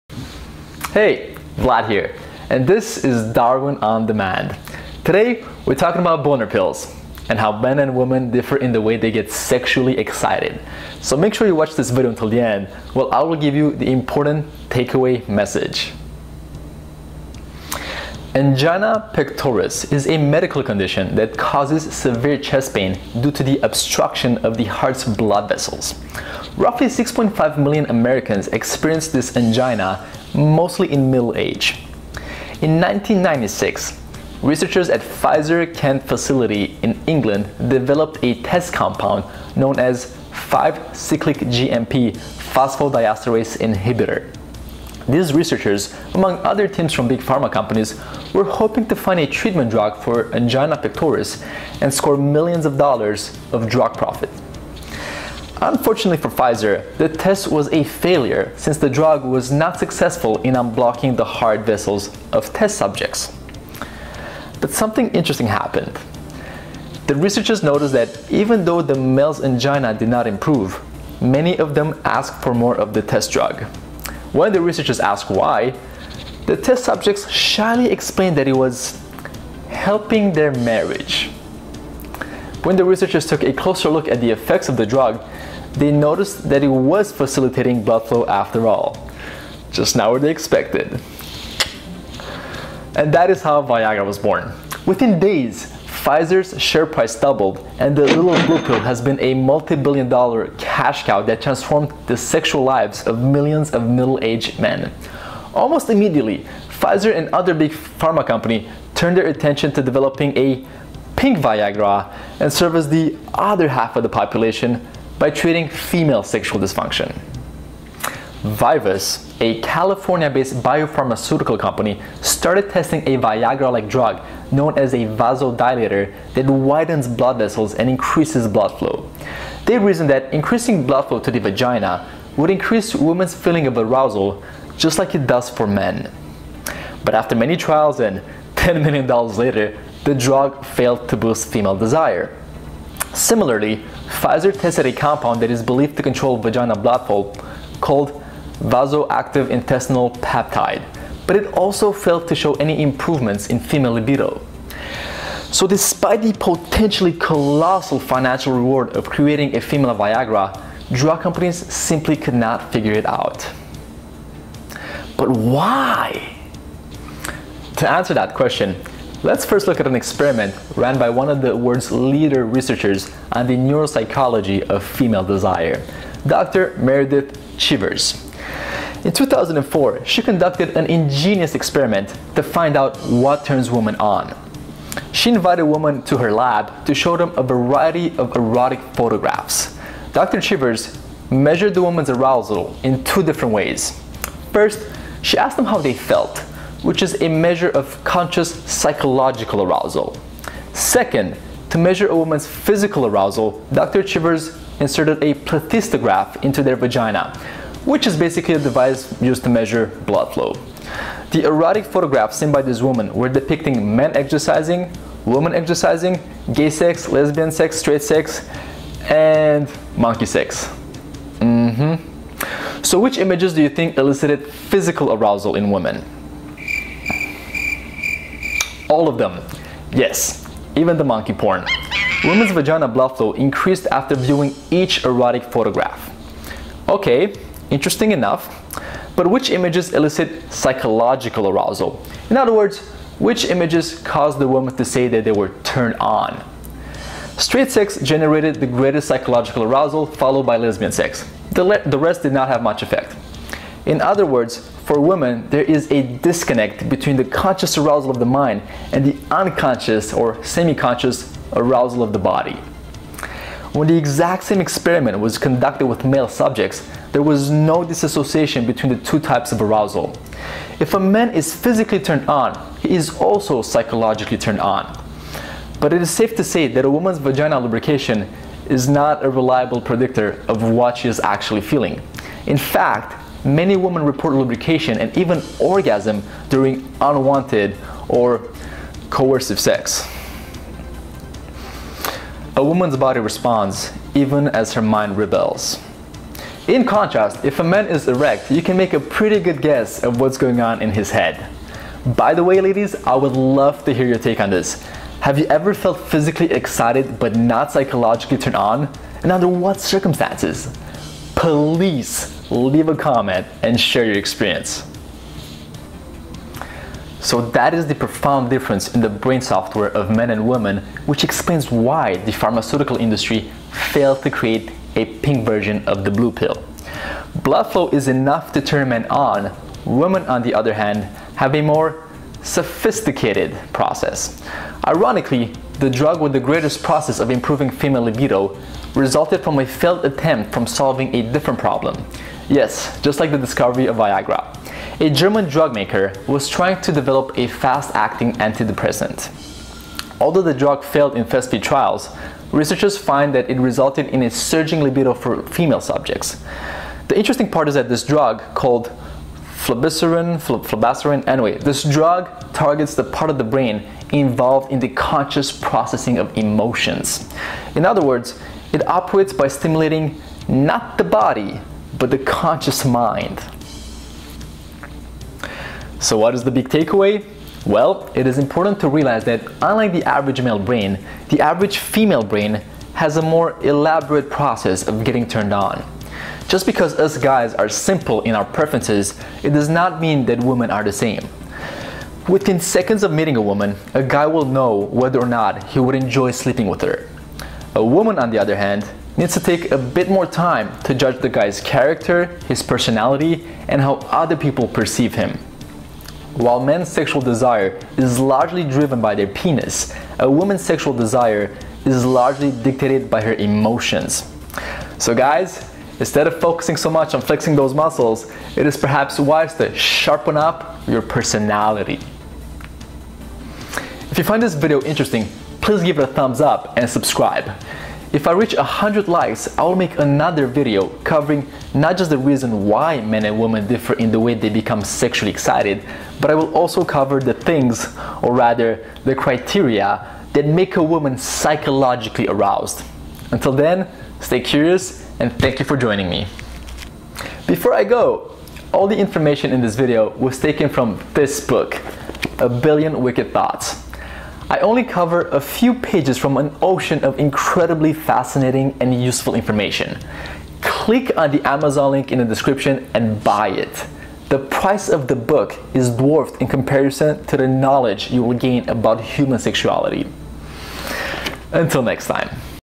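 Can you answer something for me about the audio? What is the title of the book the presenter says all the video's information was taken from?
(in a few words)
A Billion Wicked Thoughts.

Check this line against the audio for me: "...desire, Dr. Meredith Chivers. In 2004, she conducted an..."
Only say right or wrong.
right.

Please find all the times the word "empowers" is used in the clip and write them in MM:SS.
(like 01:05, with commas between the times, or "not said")
not said.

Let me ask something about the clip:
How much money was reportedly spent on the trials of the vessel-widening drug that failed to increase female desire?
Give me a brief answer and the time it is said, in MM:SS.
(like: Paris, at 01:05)
$10 million, at 02:18.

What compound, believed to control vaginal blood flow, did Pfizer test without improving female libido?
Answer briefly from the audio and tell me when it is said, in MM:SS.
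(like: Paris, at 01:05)
Vasoactive intestinal peptide, at 02:28.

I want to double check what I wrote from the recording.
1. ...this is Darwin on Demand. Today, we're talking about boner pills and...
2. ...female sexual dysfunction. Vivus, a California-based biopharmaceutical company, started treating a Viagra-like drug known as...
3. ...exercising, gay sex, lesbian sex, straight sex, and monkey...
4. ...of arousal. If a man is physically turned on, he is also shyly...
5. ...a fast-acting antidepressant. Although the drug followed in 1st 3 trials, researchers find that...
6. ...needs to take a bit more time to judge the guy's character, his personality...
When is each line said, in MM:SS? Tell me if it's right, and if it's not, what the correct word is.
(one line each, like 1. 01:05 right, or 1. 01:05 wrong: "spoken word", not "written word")
1. 00:02 right
2. 01:55 wrong: "testing", not "treating"
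3. 03:35 right
4. 04:29 wrong: "psychologically", not "shyly"
5. 05:47 wrong: "failed", not "followed"
6. 06:39 right.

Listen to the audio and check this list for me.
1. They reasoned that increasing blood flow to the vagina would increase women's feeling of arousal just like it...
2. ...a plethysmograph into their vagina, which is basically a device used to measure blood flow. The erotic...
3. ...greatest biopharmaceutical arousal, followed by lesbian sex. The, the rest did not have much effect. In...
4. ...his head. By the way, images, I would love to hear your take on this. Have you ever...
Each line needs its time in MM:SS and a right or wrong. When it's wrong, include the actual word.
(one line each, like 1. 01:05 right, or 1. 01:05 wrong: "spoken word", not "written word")
1. 02:09 right
2. 03:25 right
3. 04:08 wrong: "psychological", not "biopharmaceutical"
4. 05:00 wrong: "ladies", not "images".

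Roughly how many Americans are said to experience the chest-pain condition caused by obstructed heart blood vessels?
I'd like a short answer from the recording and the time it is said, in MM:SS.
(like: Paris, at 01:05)
6.5 million, at 00:26.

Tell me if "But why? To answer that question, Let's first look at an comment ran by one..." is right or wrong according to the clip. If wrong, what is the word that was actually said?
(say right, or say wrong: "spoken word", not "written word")
wrong: "experiment", not "comment".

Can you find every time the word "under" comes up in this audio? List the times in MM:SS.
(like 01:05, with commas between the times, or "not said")
05:09.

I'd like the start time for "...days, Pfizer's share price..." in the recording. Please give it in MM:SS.
01:35.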